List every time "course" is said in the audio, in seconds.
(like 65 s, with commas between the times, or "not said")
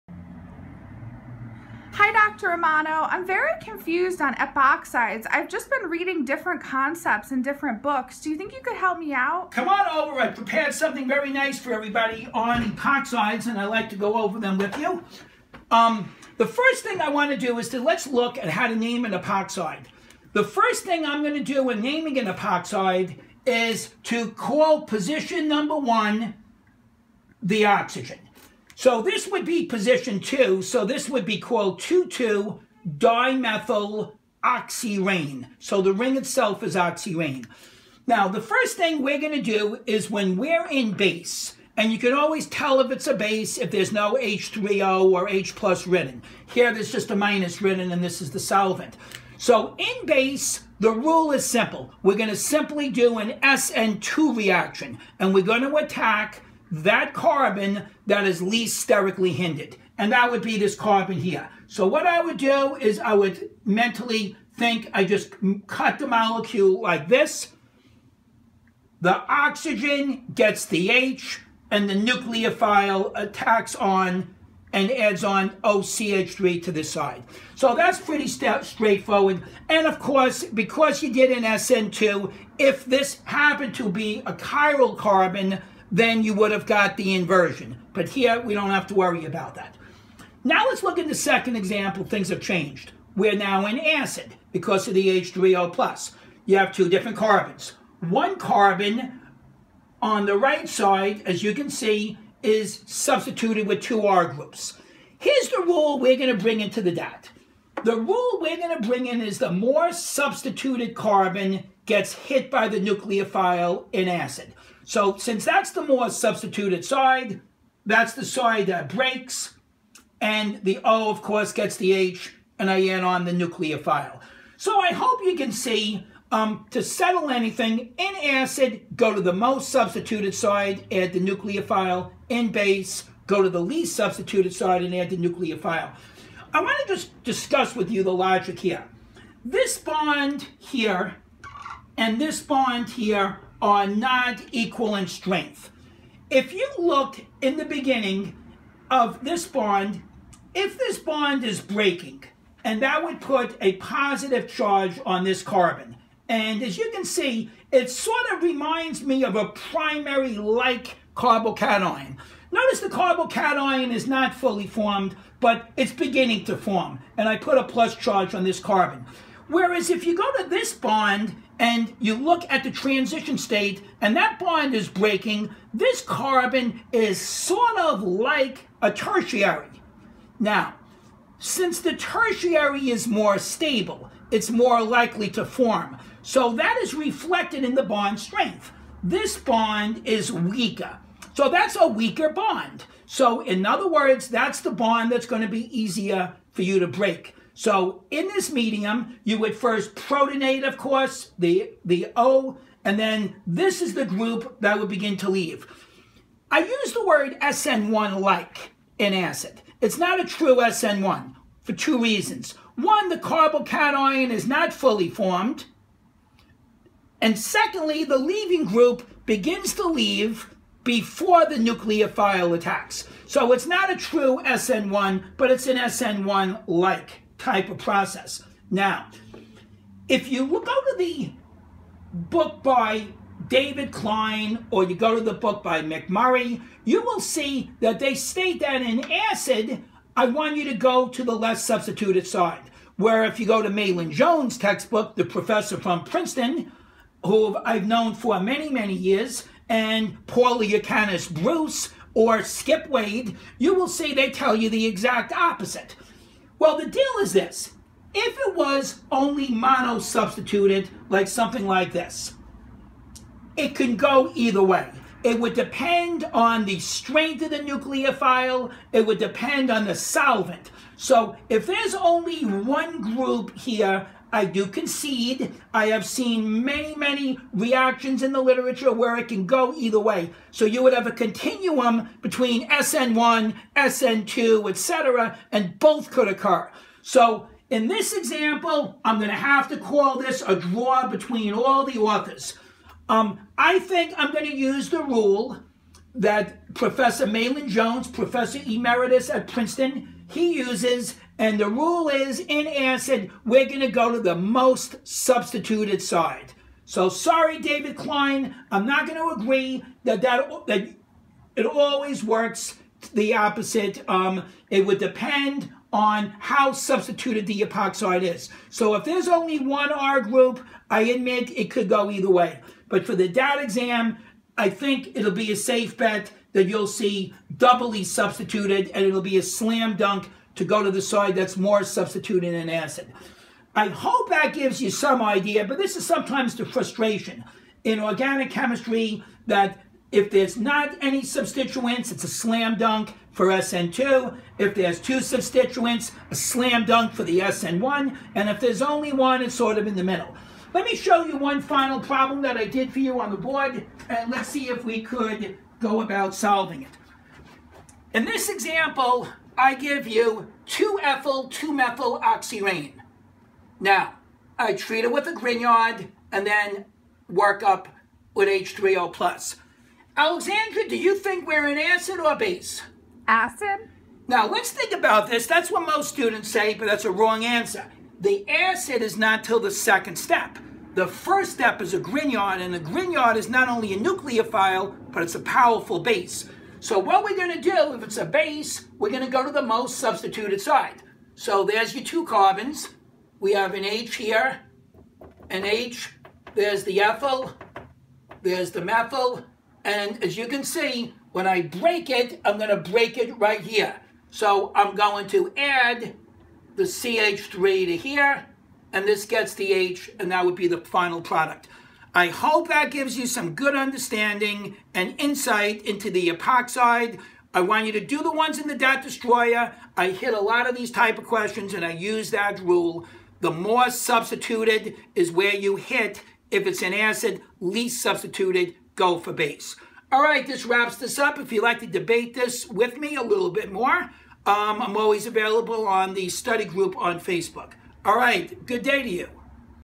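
79 s, 121 s, 200 s.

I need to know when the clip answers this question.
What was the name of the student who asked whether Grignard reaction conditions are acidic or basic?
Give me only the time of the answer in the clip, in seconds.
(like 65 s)
370 s.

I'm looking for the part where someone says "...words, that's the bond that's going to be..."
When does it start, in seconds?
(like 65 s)
193 s.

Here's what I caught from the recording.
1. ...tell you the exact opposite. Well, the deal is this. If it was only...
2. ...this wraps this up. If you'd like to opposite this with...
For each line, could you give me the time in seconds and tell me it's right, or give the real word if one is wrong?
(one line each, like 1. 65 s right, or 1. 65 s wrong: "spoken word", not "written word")
1. 254 s right
2. 430 s wrong: "debate", not "opposite".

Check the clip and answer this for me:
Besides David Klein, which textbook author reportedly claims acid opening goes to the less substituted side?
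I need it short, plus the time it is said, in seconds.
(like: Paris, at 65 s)
McMurry, at 235 s.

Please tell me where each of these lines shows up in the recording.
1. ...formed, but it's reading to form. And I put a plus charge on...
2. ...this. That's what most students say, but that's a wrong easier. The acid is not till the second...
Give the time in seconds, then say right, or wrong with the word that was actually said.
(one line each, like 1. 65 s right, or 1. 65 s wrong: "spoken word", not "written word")
1. 164 s wrong: "beginning", not "reading"
2. 375 s wrong: "answer", not "easier".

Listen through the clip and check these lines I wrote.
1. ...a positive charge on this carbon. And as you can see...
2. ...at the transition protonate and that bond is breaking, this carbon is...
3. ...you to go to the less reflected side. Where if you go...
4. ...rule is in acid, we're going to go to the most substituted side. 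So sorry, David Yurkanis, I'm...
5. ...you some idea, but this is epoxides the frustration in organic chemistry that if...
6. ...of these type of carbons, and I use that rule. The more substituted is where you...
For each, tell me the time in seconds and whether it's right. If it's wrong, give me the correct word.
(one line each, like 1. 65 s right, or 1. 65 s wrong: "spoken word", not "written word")
1. 153 s right
2. 172 s wrong: "state", not "protonate"
3. 240 s wrong: "substituted", not "reflected"
4. 301 s wrong: "Klein", not "Yurkanis"
5. 334 s wrong: "sometimes", not "epoxides"
6. 420 s wrong: "questions", not "carbons".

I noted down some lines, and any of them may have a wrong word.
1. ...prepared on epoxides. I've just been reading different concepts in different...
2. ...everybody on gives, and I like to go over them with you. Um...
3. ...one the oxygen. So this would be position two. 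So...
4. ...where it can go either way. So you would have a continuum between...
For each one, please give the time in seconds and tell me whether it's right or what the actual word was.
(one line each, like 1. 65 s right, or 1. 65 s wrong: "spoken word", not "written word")
1. 3 s wrong: "confused", not "prepared"
2. 11 s wrong: "epoxides", not "gives"
3. 25 s right
4. 278 s right.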